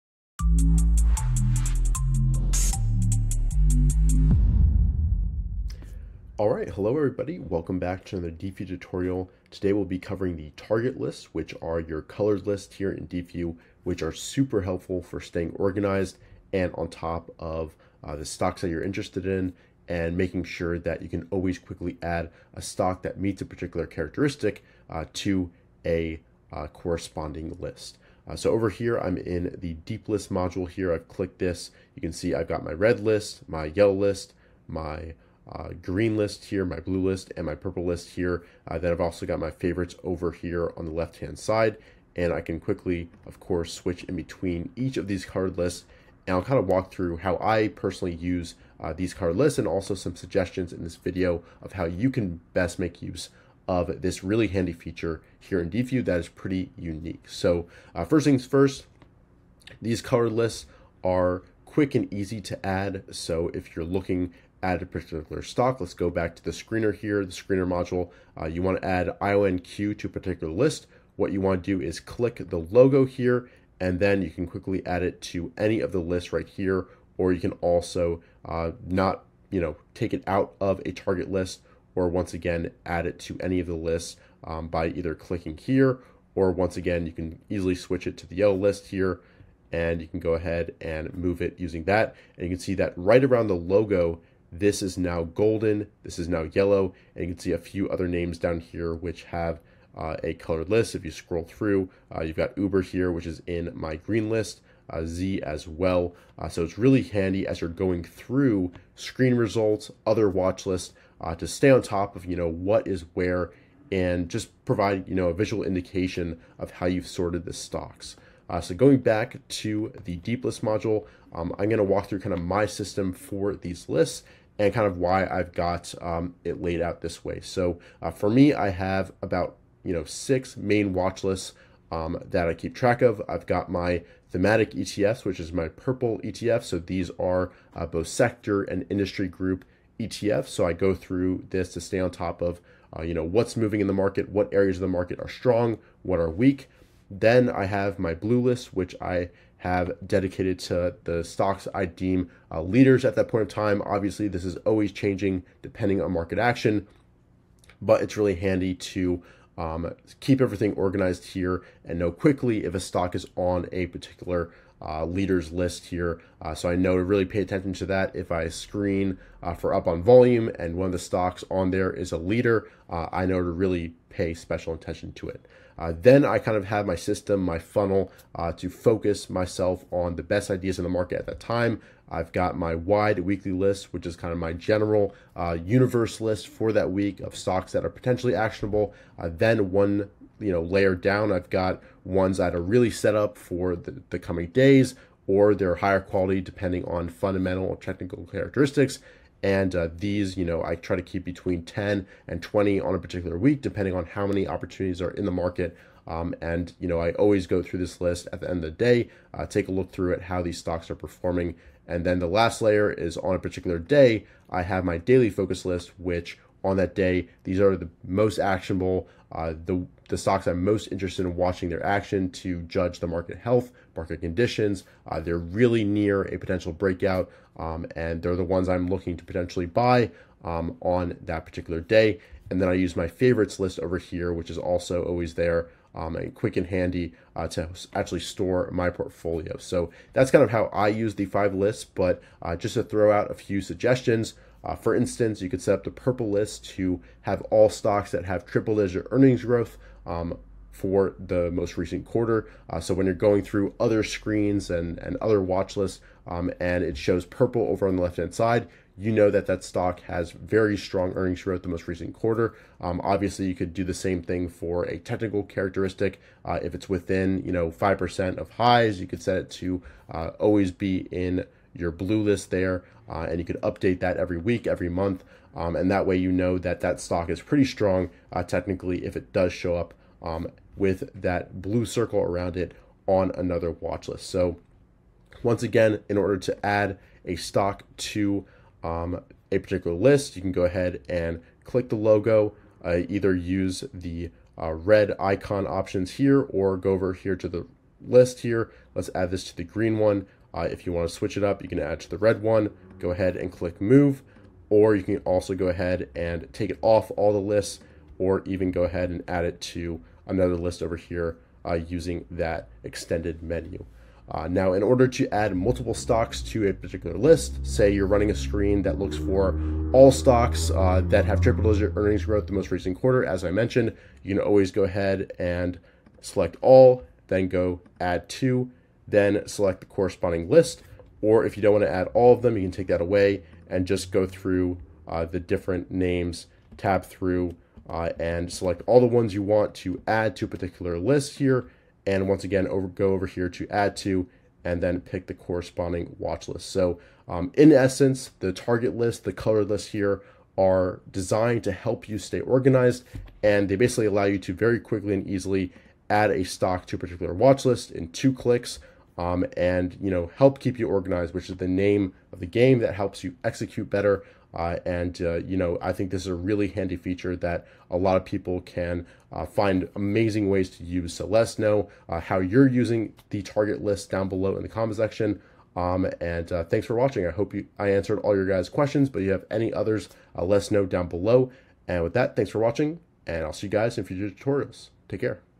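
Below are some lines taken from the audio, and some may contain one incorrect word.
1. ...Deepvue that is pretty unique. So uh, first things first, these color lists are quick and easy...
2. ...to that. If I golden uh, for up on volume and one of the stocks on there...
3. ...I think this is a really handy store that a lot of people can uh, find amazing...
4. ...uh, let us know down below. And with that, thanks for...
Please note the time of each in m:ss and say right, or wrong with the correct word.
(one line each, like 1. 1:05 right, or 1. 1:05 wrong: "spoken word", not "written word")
1. 0:55 right
2. 2:47 wrong: "screen", not "golden"
3. 6:05 wrong: "feature", not "store"
4. 6:20 right.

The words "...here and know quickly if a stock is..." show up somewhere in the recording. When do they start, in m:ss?
2:41.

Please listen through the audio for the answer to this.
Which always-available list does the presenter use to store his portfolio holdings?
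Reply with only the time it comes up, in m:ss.
3:53.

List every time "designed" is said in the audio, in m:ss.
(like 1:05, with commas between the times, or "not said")
5:51.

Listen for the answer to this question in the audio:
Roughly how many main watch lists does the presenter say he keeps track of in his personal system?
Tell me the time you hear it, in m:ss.
2:10.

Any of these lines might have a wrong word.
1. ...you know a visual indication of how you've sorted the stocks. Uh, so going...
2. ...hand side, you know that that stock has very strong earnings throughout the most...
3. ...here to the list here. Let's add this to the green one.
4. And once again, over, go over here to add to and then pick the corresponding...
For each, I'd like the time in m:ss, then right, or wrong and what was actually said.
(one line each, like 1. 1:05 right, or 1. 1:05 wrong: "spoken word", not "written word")
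1. 1:55 right
2. 4:18 right
3. 4:57 right
4. 5:42 right.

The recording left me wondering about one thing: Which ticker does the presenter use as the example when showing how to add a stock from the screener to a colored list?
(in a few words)
IONQ.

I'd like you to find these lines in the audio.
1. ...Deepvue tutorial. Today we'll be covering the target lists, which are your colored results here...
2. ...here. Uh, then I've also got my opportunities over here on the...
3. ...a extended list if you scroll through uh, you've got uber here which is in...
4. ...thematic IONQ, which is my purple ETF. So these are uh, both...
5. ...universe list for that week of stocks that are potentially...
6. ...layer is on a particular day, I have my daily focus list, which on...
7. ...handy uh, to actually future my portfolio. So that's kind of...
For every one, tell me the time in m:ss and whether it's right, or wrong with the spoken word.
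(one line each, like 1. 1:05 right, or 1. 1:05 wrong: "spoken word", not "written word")
1. 0:08 wrong: "lists", not "results"
2. 0:38 wrong: "favorites", not "opportunities"
3. 1:40 wrong: "colored", not "extended"
4. 2:14 wrong: "ETFs", not "IONQ"
5. 3:05 right
6. 3:32 right
7. 3:56 wrong: "store", not "future".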